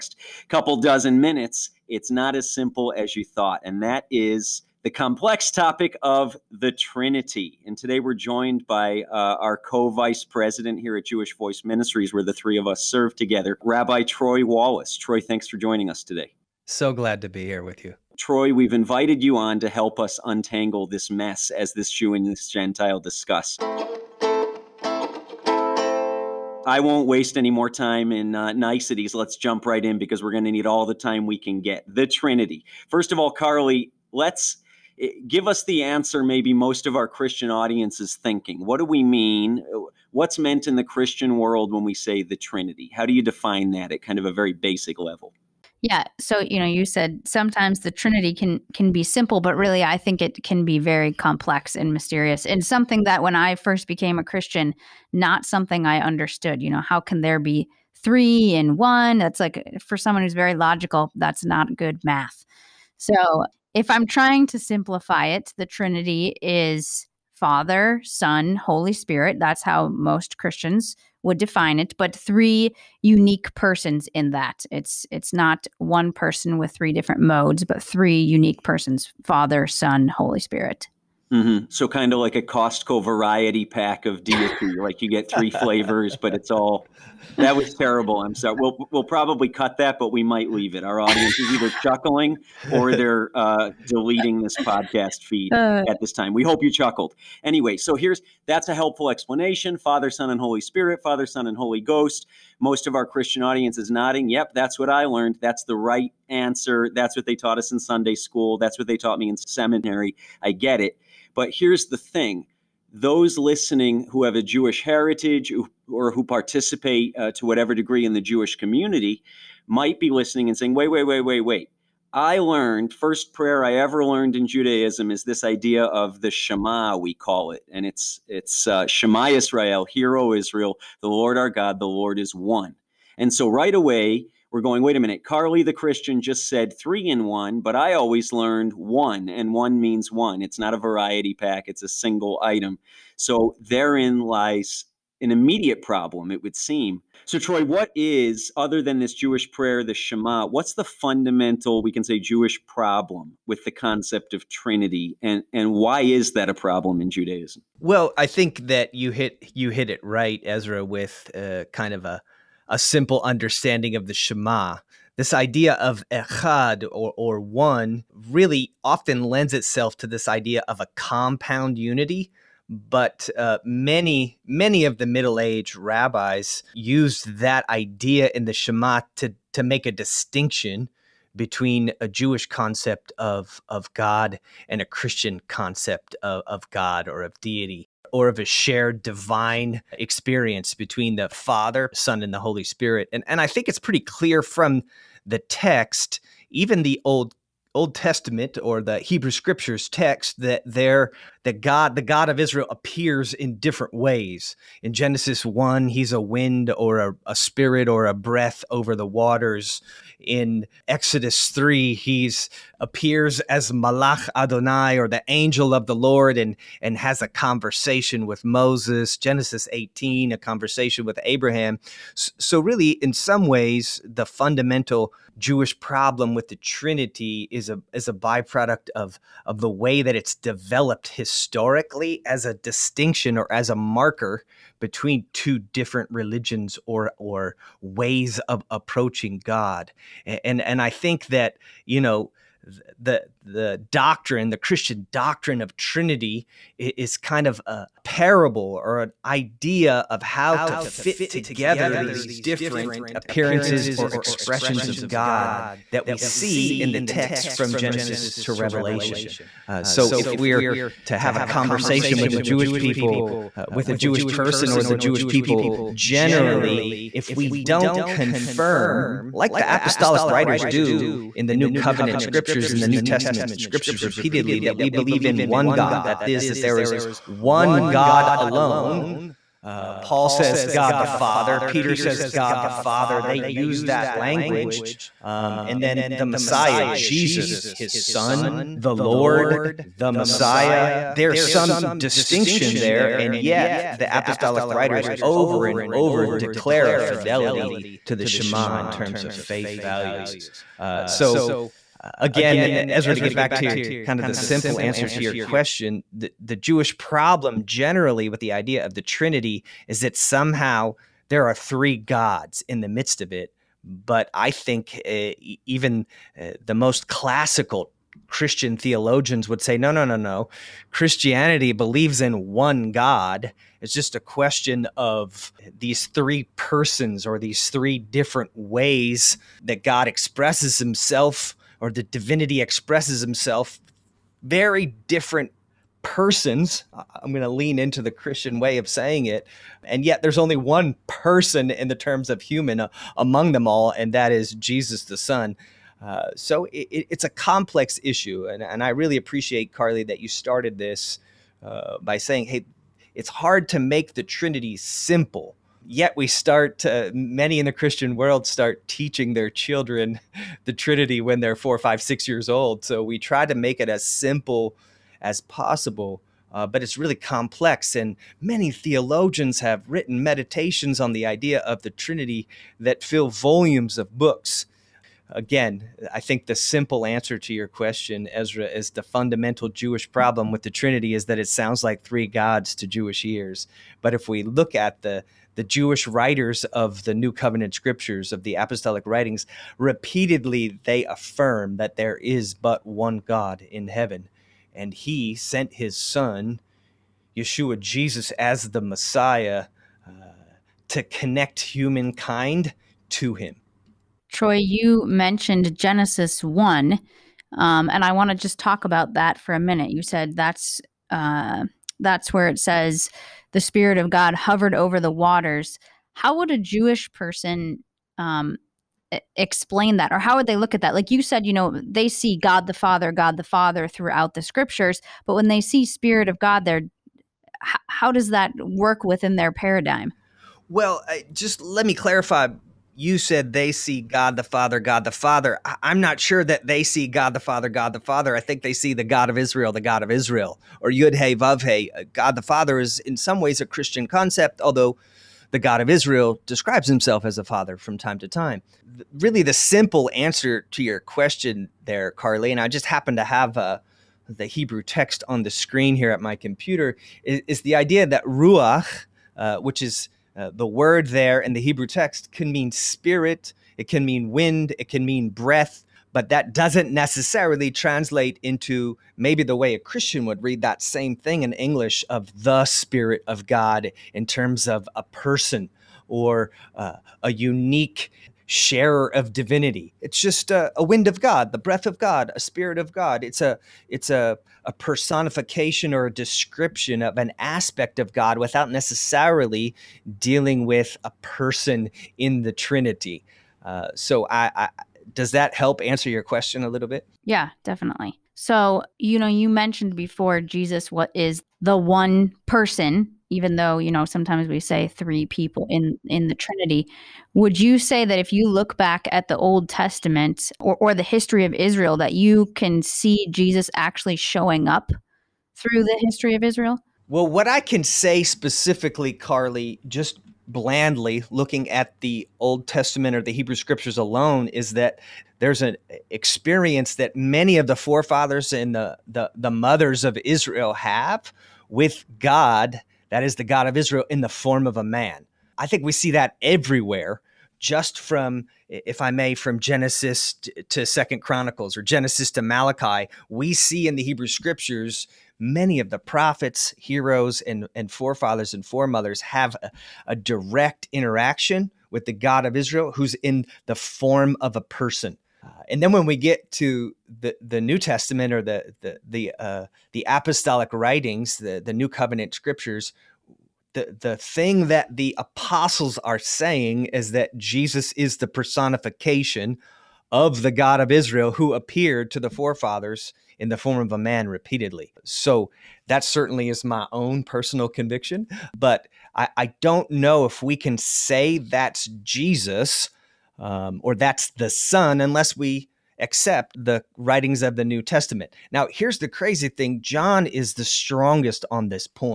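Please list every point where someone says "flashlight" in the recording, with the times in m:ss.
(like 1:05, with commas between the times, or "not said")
not said.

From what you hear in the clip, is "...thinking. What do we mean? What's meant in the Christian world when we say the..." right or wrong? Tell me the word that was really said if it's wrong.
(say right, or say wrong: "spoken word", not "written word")
right.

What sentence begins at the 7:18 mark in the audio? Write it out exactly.
I think they see the God of Israel, the God of Israel, or Yud Hey Vav Hey.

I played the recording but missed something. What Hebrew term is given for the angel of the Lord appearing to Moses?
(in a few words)
Malach Adonai.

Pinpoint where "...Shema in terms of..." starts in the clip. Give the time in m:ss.
4:58.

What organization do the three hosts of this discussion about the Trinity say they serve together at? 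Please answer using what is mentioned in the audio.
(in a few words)
Jewish Voice Ministries.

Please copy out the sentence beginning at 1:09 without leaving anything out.
That's how most Christians would define it, but three unique persons in that.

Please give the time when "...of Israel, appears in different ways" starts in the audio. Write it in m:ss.
3:22.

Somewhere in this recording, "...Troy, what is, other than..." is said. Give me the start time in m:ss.
2:27.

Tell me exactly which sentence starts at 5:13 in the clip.
But I think uh, even eh, the most classical Christian theologians would say, no, no, no, no.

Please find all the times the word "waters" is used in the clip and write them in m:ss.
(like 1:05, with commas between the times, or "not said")
3:29, 6:55.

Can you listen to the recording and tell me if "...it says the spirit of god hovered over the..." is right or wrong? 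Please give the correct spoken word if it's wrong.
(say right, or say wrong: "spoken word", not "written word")
right.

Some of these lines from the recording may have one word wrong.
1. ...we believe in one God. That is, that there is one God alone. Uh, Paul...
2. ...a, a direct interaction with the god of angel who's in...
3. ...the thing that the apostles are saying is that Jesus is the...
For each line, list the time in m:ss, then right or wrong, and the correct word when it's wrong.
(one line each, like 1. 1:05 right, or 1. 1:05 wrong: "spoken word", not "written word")
1. 4:34 right
2. 9:09 wrong: "israel", not "angel"
3. 9:23 right.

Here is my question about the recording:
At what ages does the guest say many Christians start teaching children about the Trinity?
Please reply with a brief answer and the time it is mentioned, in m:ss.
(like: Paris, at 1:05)
4, 5, 6, at 6:01.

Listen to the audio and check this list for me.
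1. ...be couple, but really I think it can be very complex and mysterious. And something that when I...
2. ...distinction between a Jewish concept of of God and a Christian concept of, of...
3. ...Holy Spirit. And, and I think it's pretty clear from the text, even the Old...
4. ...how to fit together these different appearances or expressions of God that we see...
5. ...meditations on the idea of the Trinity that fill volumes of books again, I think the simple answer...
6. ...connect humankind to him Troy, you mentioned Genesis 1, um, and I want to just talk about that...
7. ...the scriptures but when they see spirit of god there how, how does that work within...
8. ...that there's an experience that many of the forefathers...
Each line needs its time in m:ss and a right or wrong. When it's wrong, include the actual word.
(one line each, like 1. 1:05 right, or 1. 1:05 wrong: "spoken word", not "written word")
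1. 0:48 wrong: "simple", not "couple"
2. 2:59 right
3. 3:12 right
4. 4:10 right
5. 6:10 right
6. 6:41 right
7. 7:04 right
8. 8:44 right.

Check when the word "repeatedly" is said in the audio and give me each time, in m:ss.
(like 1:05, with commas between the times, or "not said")
4:34, 6:29, 9:34.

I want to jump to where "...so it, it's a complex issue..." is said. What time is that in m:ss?
5:46.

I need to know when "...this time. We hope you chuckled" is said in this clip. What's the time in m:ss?
1:36.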